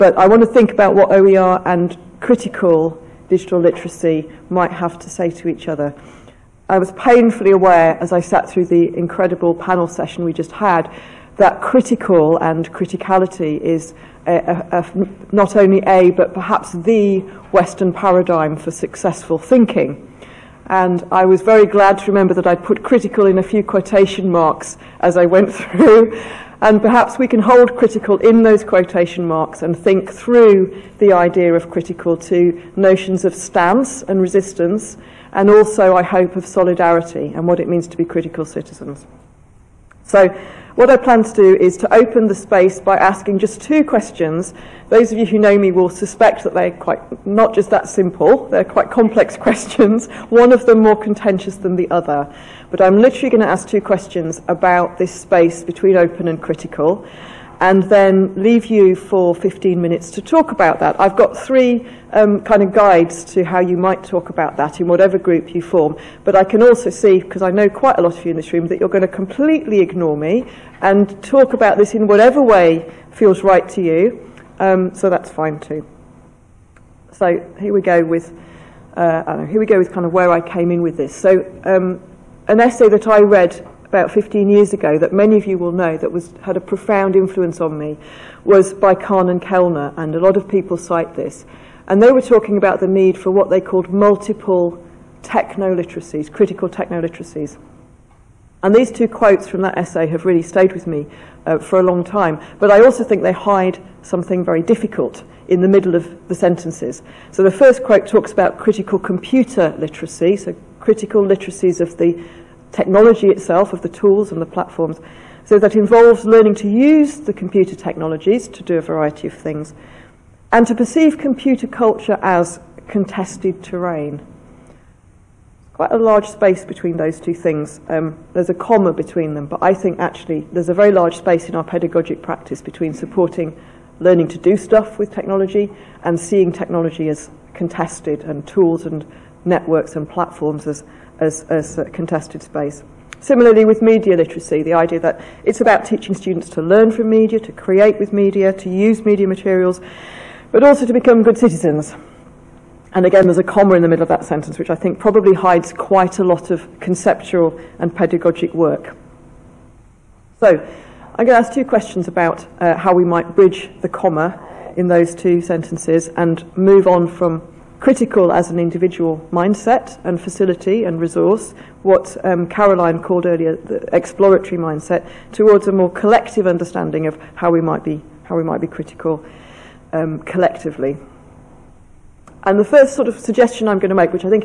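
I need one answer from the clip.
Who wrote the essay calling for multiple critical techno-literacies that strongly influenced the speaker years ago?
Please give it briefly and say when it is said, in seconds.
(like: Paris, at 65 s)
Kahn and Kellner, at 88 s.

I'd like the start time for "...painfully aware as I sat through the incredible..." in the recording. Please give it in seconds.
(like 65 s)
6 s.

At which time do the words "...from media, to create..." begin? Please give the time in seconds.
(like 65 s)
146 s.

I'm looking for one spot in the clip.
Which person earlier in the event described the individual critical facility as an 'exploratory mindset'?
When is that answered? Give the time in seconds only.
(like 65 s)
172 s.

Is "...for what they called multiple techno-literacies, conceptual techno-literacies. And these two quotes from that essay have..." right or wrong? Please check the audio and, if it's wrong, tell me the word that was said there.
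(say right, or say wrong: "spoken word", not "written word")
wrong: "critical", not "conceptual".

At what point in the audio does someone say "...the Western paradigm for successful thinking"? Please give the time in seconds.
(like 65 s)
16 s.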